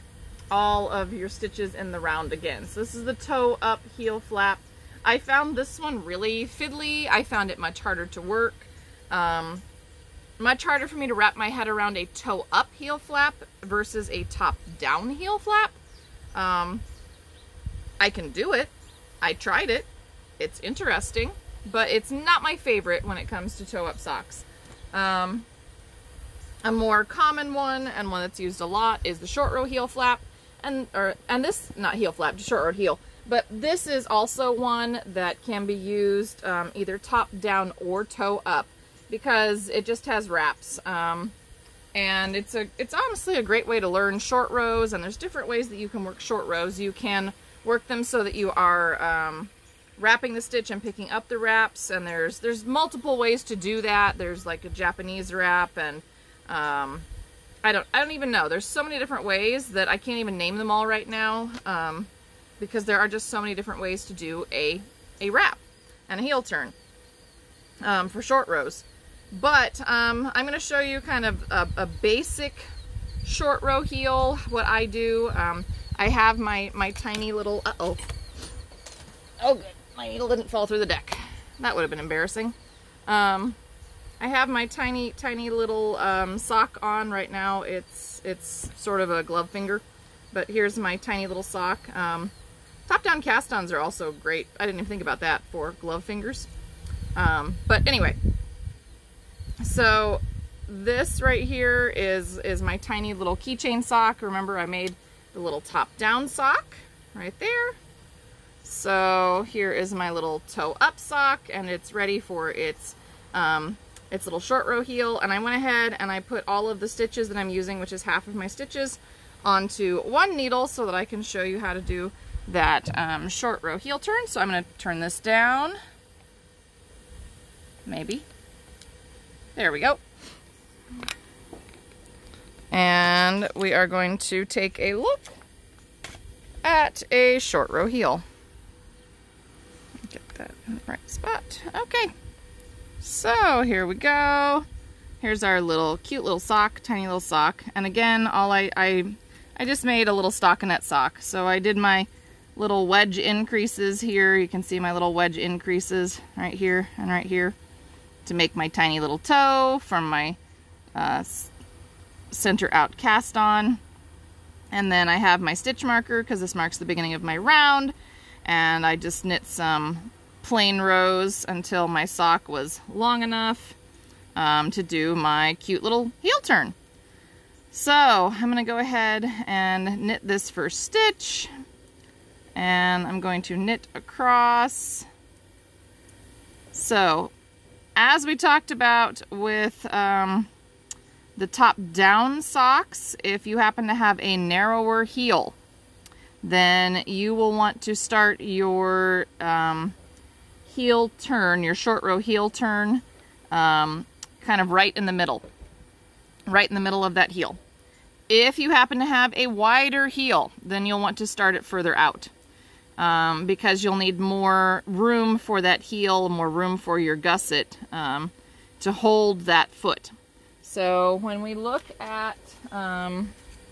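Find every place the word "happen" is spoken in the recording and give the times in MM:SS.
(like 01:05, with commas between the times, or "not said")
03:13, 03:28.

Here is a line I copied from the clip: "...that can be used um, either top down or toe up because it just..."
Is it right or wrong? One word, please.
right.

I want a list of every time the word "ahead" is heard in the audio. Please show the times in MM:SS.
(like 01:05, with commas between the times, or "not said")
01:55, 02:58.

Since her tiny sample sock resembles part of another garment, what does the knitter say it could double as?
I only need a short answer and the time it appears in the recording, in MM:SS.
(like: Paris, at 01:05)
keychain, at 01:43.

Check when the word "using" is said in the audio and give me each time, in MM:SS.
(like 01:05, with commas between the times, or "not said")
01:57.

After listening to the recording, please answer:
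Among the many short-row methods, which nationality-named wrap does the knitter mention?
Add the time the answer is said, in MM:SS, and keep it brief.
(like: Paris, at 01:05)
Japanese wrap, at 00:54.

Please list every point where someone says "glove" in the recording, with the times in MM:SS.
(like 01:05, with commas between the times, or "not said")
01:29, 01:35.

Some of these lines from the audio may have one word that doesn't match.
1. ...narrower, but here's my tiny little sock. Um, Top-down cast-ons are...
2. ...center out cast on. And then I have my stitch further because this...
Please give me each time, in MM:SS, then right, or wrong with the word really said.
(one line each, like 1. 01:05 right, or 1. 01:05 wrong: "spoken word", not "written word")
1. 01:29 wrong: "finger", not "narrower"
2. 02:42 wrong: "marker", not "further".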